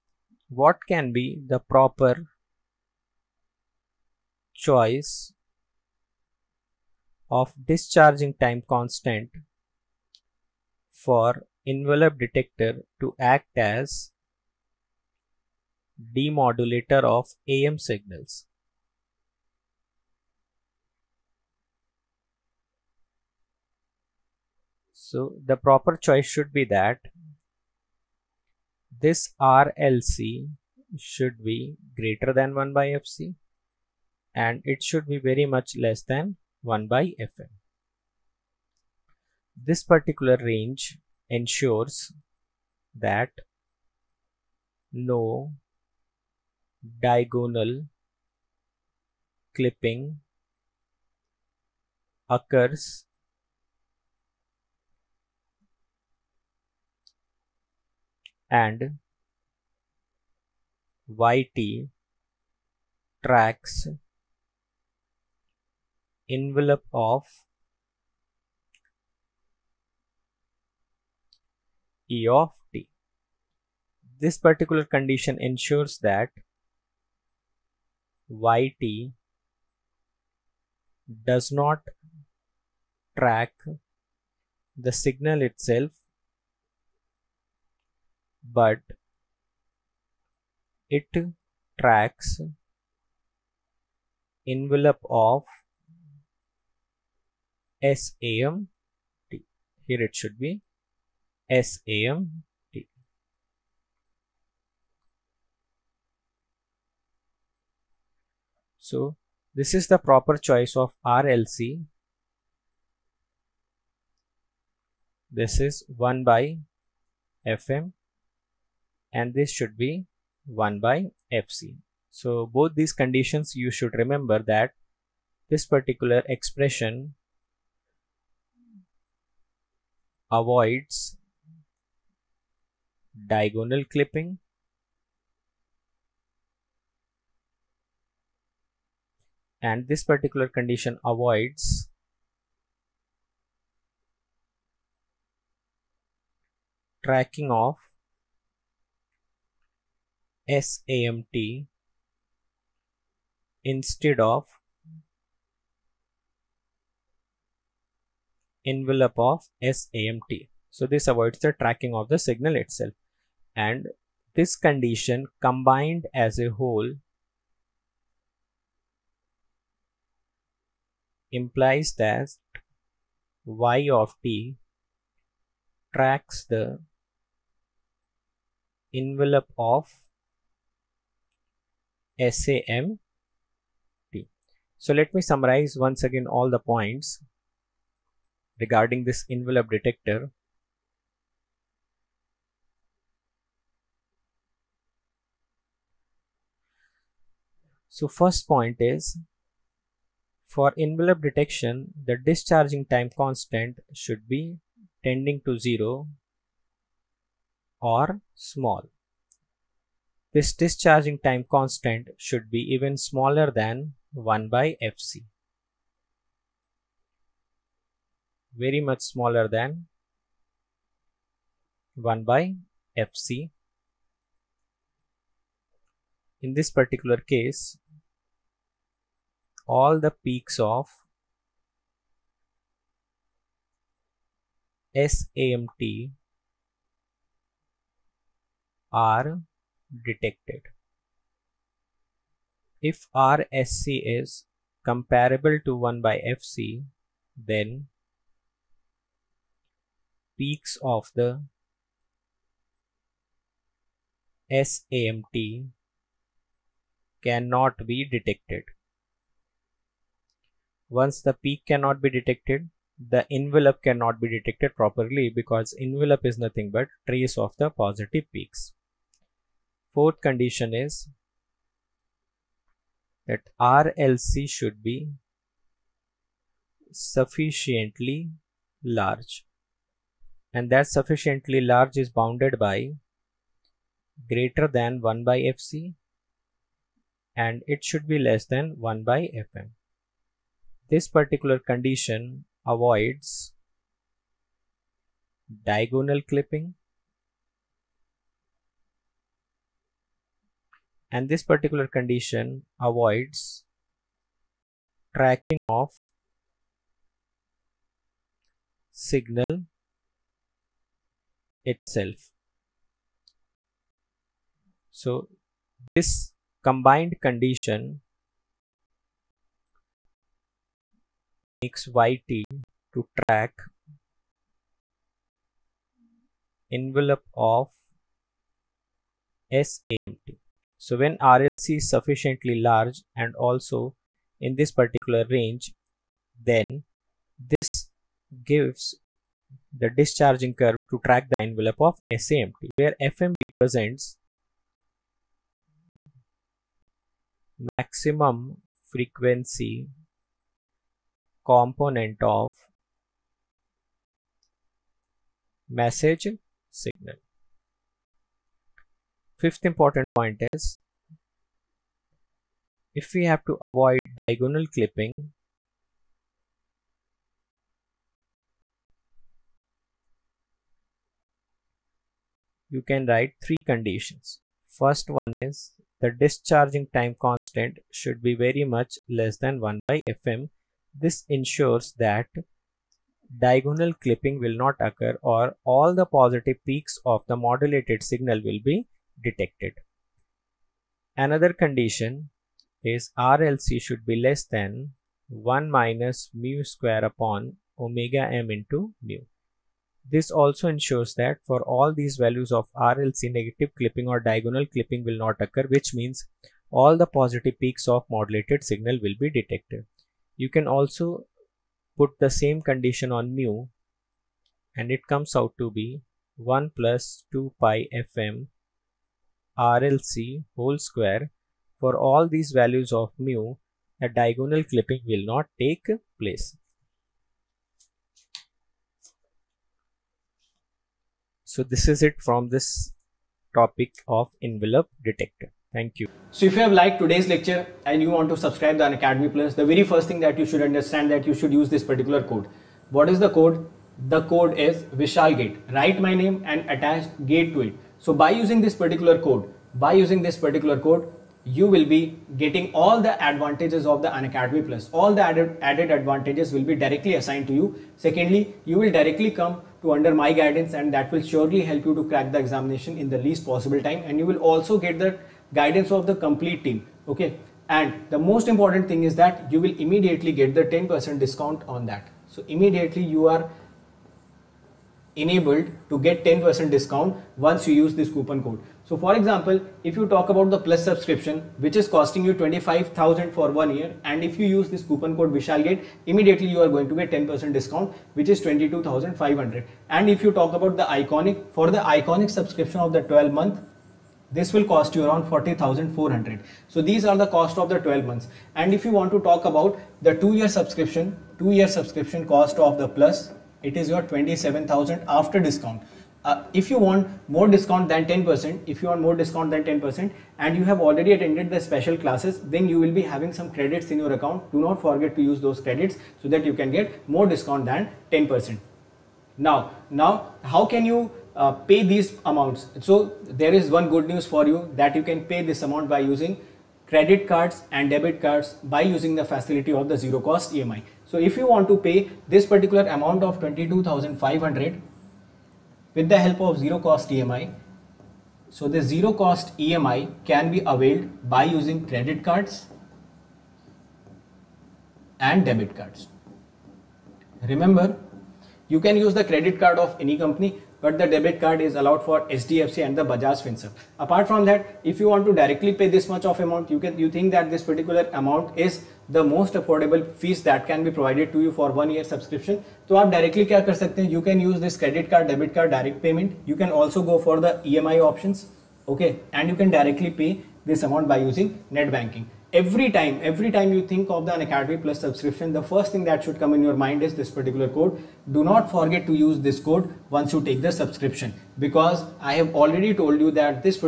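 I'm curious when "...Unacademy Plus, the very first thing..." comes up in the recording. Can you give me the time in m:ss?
7:18.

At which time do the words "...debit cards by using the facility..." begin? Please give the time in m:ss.
8:47.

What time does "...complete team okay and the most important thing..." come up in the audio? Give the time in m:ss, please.
7:46.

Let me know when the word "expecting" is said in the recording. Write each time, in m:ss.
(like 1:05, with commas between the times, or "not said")
not said.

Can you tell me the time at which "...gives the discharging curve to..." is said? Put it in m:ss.
5:38.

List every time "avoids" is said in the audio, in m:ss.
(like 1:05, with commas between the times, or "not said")
2:10, 2:21, 2:41, 4:52, 5:02, 6:03.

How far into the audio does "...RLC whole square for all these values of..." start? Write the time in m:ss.
6:59.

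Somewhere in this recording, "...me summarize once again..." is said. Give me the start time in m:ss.
3:05.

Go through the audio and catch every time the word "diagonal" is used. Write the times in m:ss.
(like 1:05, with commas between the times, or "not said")
0:47, 2:13, 4:55, 6:04, 6:23, 6:44, 7:04.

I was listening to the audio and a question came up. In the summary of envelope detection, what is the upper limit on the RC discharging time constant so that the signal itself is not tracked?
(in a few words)
1/fm.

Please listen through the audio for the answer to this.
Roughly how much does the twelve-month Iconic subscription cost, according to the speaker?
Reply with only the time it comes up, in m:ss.
8:15.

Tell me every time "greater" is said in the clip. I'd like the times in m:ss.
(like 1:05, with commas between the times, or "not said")
0:31, 4:44.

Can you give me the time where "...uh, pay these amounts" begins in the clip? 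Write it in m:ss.
8:41.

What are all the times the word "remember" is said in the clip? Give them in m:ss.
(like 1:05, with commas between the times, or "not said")
2:03, 9:07.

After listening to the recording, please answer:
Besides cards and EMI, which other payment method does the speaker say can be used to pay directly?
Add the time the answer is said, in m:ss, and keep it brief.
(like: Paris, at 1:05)
Net banking, at 9:31.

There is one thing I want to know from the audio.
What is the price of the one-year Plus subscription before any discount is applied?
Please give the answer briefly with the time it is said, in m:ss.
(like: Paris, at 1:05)
25000, at 8:02.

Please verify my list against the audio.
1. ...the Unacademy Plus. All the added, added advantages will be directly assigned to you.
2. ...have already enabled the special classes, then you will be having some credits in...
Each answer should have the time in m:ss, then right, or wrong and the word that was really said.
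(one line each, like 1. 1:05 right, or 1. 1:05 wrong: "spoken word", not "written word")
1. 7:34 right
2. 8:30 wrong: "attended", not "enabled".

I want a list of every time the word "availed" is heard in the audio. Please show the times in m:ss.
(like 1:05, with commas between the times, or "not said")
9:00.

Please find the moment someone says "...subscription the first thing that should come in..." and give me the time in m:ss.
9:35.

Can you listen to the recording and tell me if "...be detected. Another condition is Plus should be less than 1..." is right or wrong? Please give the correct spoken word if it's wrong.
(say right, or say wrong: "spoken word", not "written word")
wrong: "RLC", not "Plus".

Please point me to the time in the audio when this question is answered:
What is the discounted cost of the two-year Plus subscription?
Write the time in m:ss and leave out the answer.
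8:24.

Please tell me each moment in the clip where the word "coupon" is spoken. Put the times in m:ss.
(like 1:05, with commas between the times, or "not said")
7:58, 8:04.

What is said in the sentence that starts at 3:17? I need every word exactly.
So first point is for envelope detection, the discharging time constant should be tending to zero or small.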